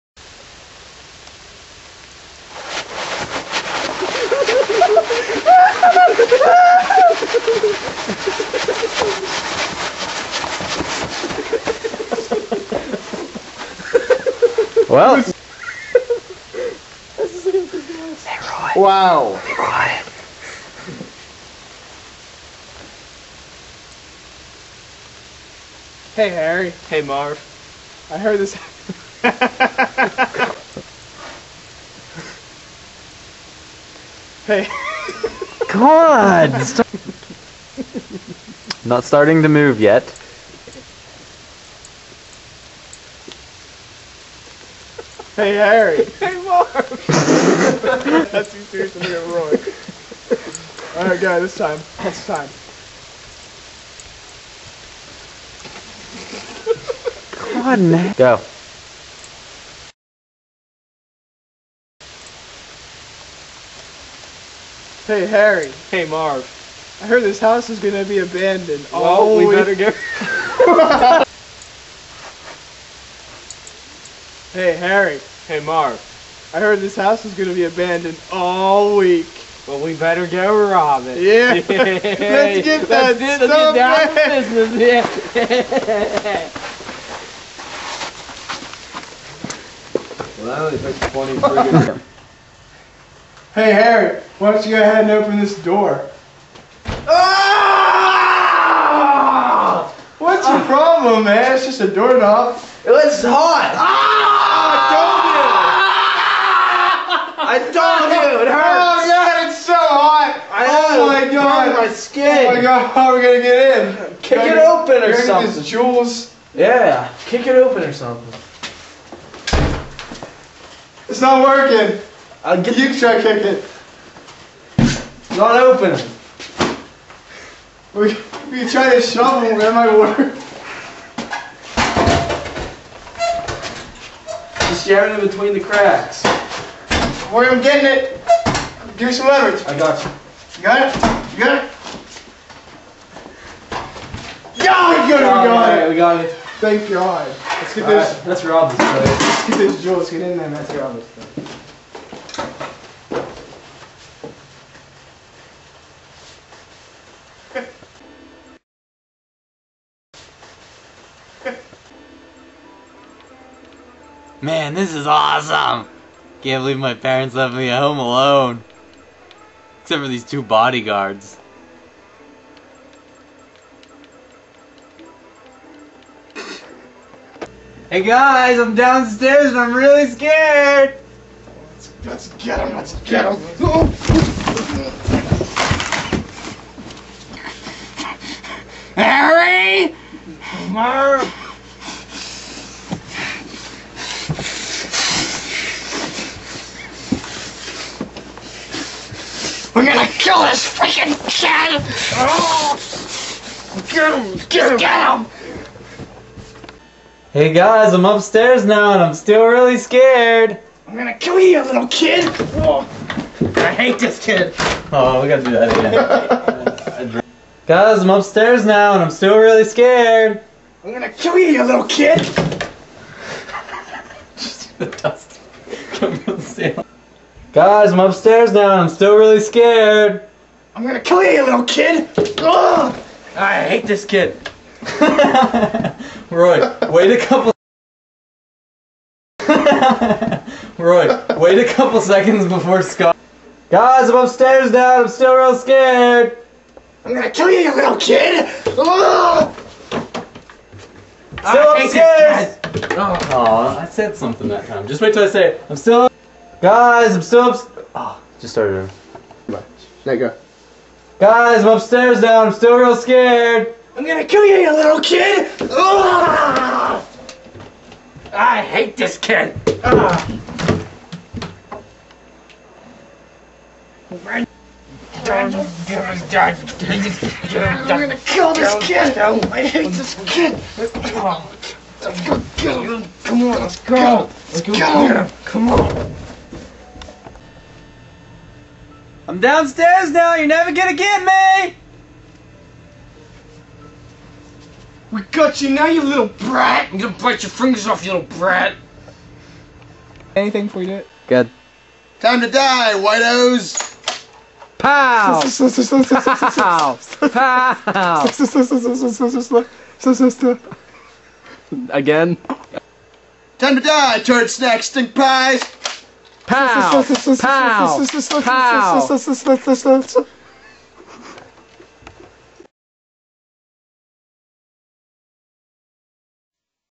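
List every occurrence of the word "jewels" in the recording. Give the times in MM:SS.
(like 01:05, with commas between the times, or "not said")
01:55, 02:29.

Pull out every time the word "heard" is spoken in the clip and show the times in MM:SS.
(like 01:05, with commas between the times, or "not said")
00:28, 01:07, 01:16.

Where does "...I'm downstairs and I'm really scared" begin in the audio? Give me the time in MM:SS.
02:58.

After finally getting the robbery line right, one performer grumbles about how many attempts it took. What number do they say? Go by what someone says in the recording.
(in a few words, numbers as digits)
20.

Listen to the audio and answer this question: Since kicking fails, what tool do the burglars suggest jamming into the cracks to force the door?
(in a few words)
Shovel.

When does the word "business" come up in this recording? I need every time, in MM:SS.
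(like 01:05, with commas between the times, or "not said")
01:24.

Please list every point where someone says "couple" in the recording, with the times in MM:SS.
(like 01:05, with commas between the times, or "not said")
03:57, 04:01.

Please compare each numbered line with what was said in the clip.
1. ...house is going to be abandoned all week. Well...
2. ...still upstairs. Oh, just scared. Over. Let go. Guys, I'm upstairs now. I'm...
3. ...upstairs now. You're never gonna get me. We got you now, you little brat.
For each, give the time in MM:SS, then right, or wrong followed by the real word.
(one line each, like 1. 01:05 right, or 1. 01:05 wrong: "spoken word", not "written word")
1. 01:16 right
2. 04:17 wrong: "started", not "scared"
3. 04:49 wrong: "downstairs", not "upstairs".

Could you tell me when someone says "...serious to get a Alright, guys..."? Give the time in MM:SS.
00:48.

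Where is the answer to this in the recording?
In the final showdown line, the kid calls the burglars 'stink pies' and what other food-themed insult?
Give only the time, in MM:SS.
05:14.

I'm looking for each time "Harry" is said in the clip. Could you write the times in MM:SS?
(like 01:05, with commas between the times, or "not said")
00:26, 00:45, 01:05, 01:14, 01:33, 03:08.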